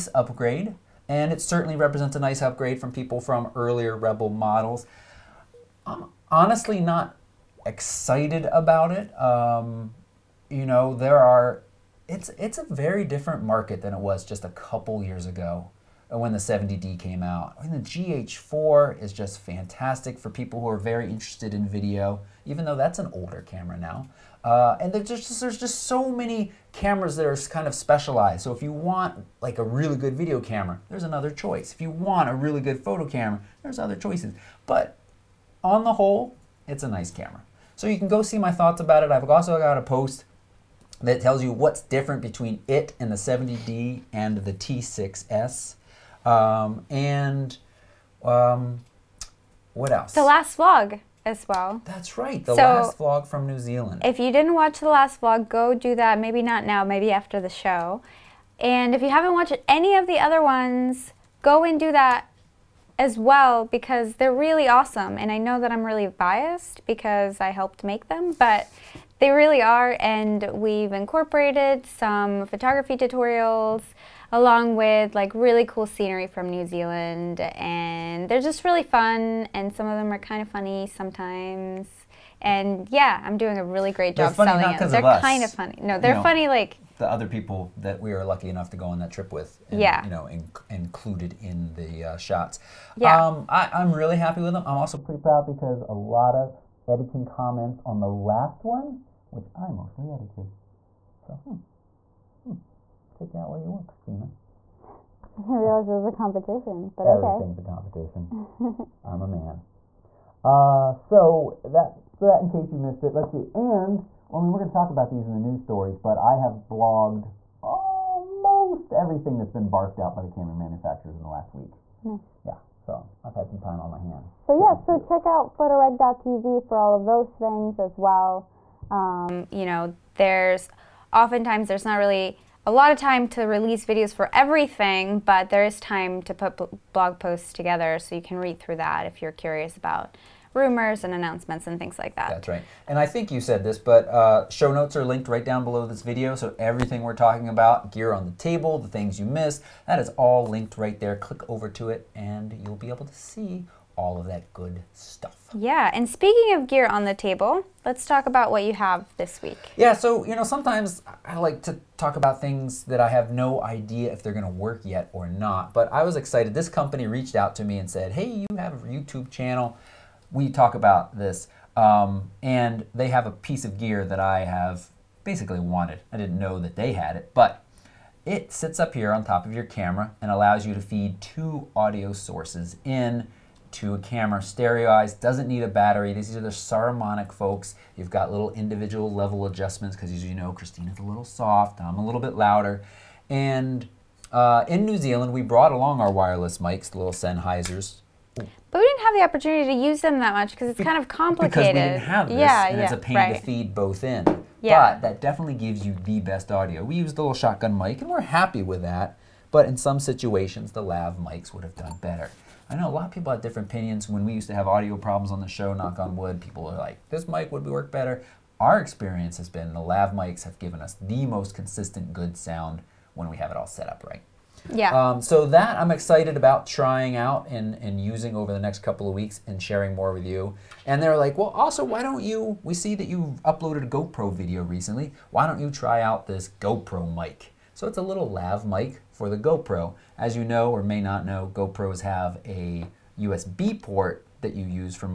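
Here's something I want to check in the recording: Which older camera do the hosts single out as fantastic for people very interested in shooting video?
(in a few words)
GH4.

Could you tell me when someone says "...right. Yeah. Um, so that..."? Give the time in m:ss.
3:44.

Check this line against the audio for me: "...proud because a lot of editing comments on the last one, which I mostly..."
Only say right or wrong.
right.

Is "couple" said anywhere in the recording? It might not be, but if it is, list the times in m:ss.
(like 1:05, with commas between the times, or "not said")
0:14, 3:48.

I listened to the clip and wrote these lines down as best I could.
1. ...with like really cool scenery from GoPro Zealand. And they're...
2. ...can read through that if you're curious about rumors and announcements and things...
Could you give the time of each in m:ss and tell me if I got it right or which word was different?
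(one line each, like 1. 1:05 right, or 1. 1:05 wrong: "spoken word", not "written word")
1. 1:14 wrong: "New", not "GoPro"
2. 2:18 right.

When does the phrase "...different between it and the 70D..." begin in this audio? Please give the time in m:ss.
0:41.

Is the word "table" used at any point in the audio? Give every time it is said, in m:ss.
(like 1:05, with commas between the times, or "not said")
2:28, 2:37.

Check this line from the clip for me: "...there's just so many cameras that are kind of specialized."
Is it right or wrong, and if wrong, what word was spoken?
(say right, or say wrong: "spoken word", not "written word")
right.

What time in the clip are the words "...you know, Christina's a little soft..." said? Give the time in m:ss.
3:10.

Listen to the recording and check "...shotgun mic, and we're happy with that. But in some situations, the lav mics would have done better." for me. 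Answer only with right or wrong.
right.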